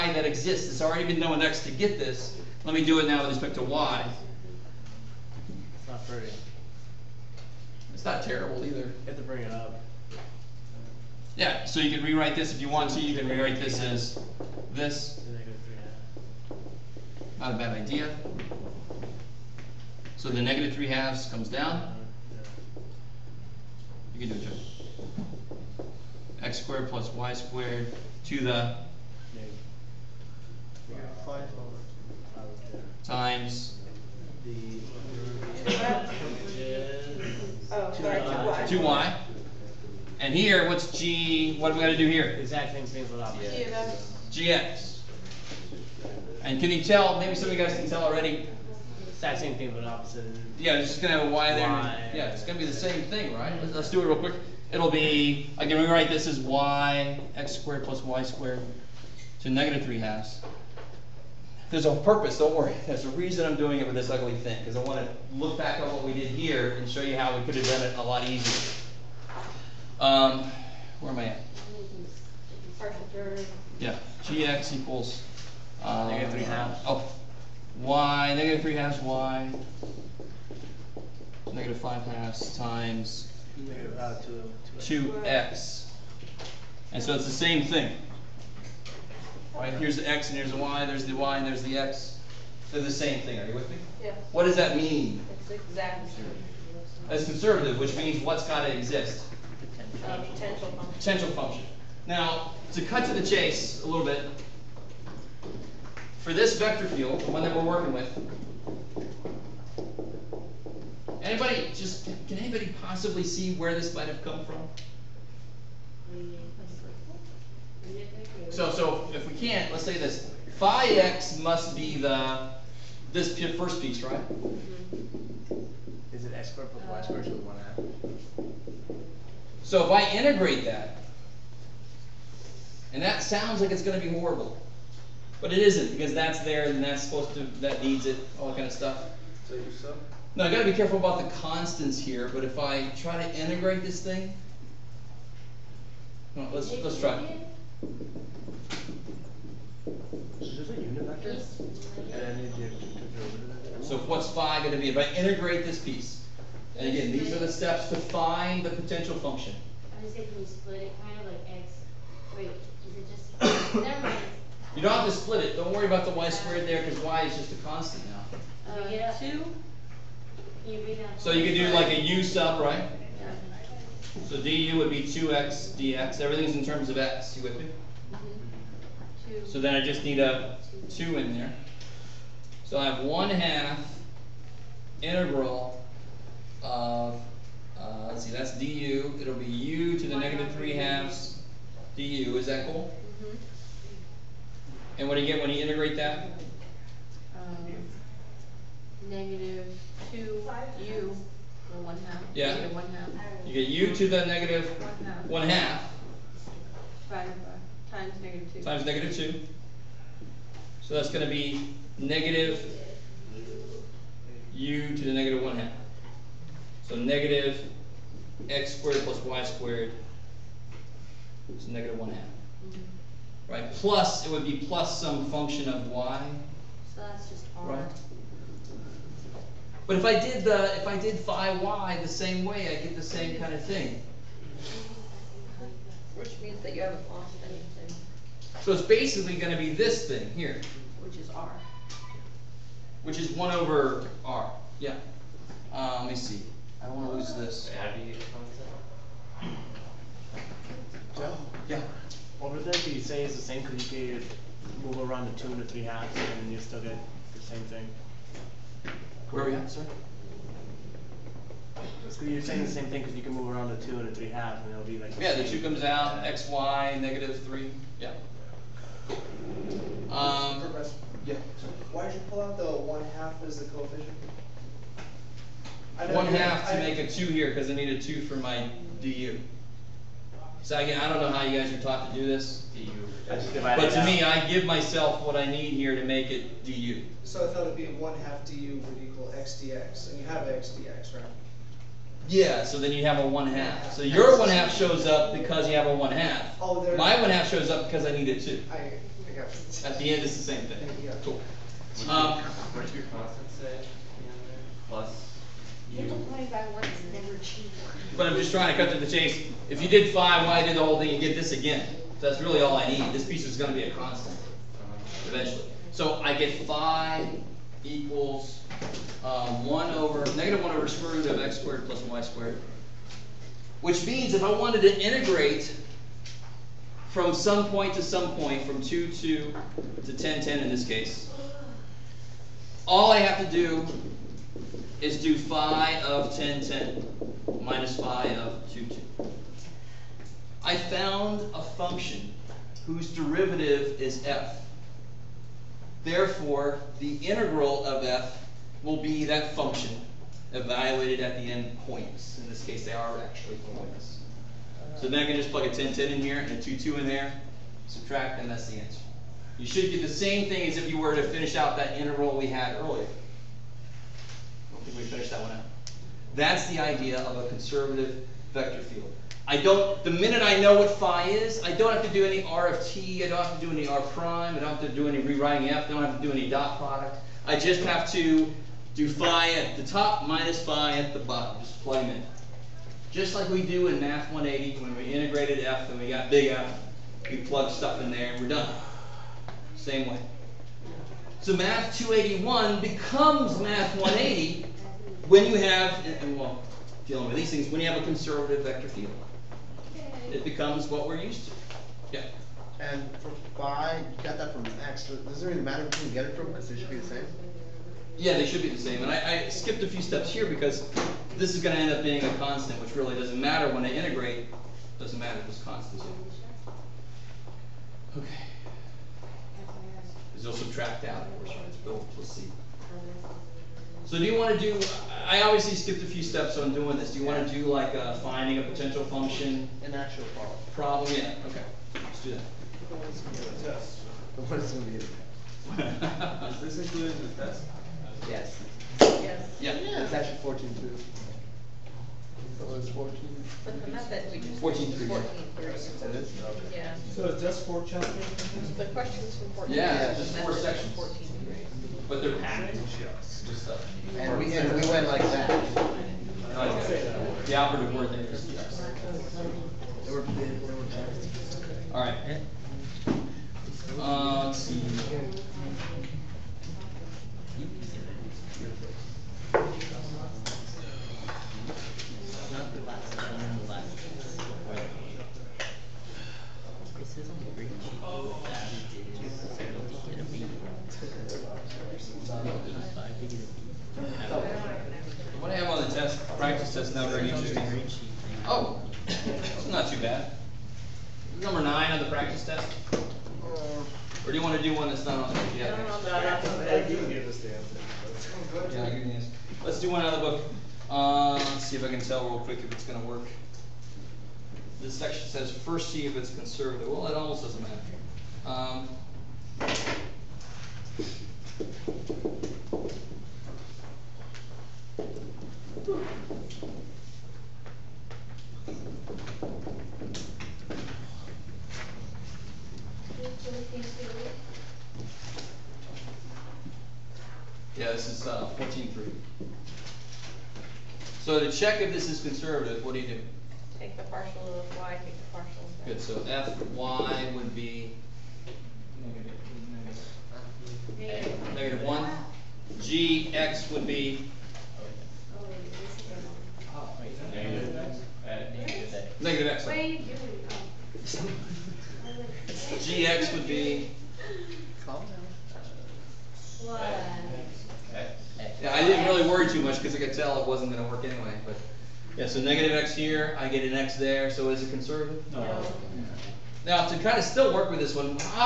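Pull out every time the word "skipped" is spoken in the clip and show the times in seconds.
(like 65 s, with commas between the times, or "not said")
409 s, 425 s.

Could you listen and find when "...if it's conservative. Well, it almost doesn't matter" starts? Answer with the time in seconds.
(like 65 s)
506 s.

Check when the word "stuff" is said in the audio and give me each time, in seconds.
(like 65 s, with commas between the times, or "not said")
138 s, 387 s, 453 s.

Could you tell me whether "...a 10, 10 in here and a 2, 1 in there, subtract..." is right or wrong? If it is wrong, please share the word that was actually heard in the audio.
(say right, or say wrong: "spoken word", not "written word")
wrong: "2", not "1".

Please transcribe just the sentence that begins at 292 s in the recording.
Yeah, so then you have a one half.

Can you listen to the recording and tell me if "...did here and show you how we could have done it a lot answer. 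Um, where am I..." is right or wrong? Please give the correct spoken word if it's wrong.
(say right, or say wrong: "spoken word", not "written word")
wrong: "easier", not "answer".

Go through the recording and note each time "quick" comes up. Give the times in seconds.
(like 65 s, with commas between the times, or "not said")
54 s, 502 s.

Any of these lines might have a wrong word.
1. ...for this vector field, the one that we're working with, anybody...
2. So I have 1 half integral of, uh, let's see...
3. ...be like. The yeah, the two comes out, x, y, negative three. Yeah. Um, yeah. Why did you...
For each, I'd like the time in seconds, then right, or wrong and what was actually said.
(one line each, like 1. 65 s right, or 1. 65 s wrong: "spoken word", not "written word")
1. 106 s right
2. 182 s right
3. 264 s right.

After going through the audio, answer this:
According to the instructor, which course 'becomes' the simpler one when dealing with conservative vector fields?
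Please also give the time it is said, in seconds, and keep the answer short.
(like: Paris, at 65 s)
Math 281, at 391 s.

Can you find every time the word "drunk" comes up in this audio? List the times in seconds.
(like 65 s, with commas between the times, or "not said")
not said.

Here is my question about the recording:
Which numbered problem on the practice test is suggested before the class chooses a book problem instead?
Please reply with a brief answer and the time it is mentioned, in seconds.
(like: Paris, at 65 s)
Number nine, at 491 s.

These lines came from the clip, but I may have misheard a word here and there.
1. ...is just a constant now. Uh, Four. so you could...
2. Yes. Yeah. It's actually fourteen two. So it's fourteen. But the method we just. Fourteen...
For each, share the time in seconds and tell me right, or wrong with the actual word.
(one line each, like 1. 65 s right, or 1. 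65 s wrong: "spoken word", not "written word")
1. 167 s wrong: "Two", not "Four"
2. 439 s right.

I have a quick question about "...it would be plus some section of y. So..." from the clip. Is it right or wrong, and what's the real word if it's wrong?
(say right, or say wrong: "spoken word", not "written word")
wrong: "function", not "section".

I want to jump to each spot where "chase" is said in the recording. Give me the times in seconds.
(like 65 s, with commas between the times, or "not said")
103 s, 309 s.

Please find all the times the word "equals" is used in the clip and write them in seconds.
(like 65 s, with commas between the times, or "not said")
74 s, 127 s, 289 s, 317 s.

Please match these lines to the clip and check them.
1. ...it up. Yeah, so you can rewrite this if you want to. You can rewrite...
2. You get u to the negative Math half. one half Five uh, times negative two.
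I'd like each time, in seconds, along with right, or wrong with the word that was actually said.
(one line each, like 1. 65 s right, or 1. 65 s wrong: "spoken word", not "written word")
1. 9 s right
2. 203 s wrong: "One", not "Math".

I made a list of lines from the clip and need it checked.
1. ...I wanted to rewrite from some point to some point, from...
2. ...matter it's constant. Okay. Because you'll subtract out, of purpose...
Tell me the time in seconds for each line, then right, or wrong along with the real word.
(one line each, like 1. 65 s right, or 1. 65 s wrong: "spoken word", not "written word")
1. 324 s wrong: "integrate", not "rewrite"
2. 415 s wrong: "course", not "purpose".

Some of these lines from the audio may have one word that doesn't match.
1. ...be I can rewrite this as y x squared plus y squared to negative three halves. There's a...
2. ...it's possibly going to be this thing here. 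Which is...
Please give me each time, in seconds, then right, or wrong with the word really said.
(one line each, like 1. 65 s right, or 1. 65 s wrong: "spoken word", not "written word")
1. 54 s right
2. 238 s wrong: "basically", not "possibly".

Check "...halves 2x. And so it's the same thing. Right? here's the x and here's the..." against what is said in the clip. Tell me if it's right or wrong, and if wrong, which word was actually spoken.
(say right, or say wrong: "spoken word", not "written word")
wrong: "times", not "halves".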